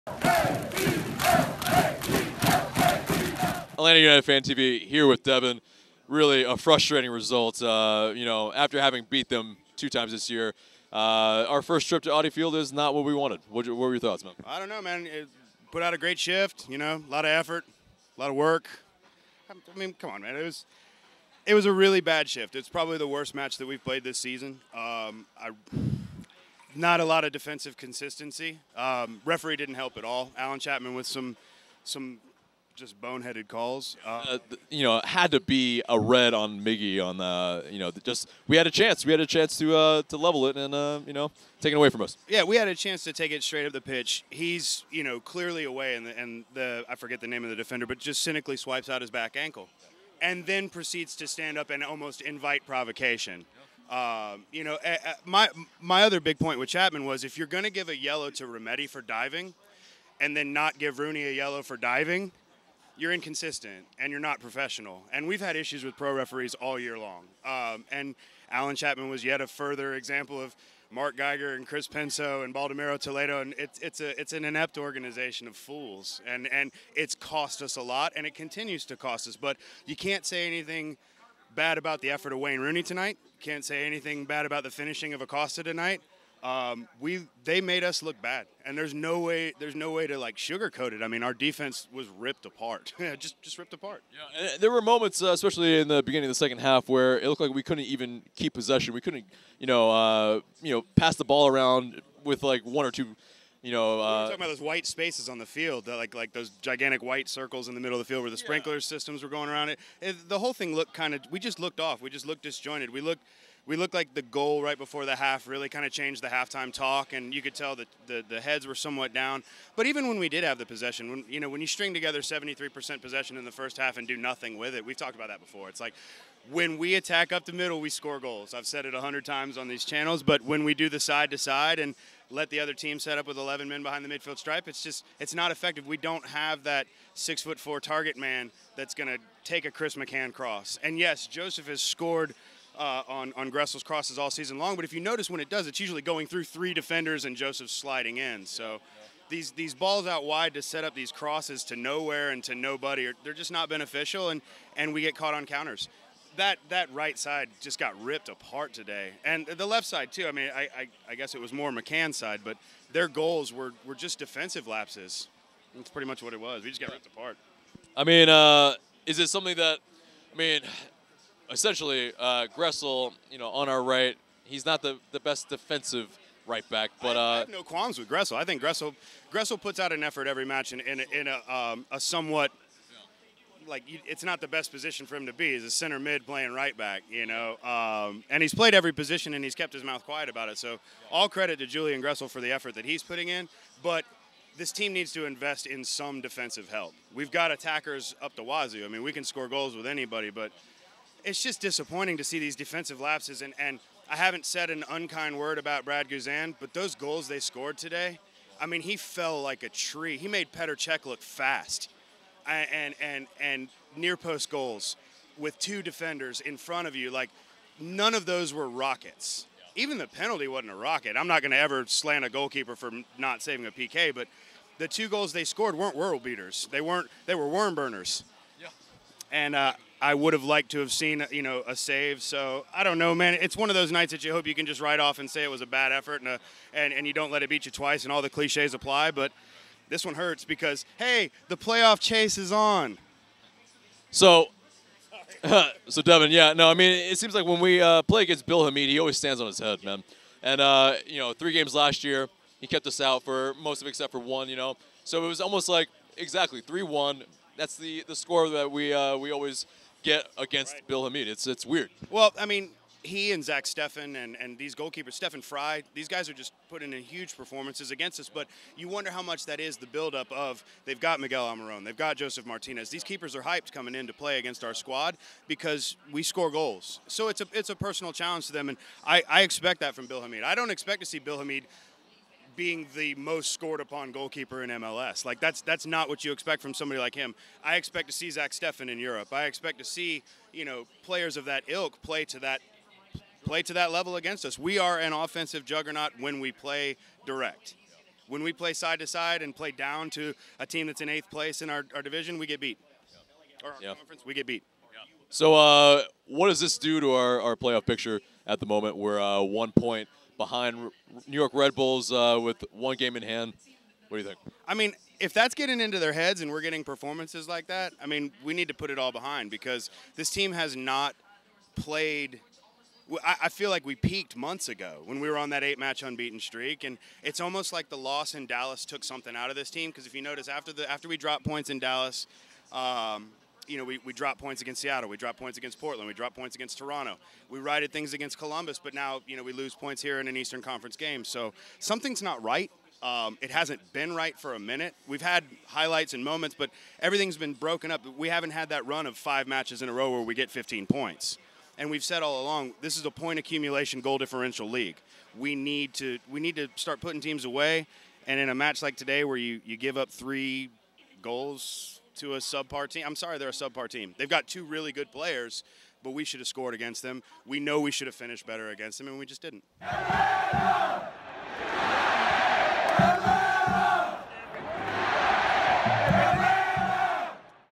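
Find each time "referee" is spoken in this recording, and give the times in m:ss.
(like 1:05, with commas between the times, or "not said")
0:29, 1:06.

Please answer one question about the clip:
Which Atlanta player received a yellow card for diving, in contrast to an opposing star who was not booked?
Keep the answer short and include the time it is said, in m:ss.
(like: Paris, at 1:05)
Remedi, at 0:58.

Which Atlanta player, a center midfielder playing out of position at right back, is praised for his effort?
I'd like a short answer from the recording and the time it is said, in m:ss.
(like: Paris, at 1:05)
Julian Gressel, at 3:11.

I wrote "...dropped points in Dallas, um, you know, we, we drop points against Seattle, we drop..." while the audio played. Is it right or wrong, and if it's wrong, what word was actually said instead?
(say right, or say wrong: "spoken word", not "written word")
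right.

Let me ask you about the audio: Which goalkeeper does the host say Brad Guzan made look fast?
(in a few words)
Petr Cech.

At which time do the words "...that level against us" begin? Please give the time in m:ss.
4:53.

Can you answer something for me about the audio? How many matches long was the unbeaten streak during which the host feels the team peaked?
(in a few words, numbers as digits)
8.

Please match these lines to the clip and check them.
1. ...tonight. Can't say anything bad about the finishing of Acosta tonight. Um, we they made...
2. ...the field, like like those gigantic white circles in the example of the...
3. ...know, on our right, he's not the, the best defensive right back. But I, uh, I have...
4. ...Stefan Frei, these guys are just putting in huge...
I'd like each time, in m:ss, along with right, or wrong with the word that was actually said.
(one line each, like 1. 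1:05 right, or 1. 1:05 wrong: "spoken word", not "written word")
1. 1:22 right
2. 1:45 wrong: "middle", not "example"
3. 2:53 right
4. 4:25 right.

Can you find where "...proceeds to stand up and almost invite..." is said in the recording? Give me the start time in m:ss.
0:50.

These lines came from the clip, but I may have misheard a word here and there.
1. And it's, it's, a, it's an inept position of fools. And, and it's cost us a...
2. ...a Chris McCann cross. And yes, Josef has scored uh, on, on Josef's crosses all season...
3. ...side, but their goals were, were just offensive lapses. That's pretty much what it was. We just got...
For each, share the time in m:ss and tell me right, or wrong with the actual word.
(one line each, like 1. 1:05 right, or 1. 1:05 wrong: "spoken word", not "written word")
1. 1:13 wrong: "organization", not "position"
2. 2:19 wrong: "Gressel", not "Josef"
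3. 2:42 wrong: "defensive", not "offensive".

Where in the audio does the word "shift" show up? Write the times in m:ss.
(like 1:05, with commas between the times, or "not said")
0:16, 0:22.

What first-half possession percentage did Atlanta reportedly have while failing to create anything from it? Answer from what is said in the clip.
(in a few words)
73%.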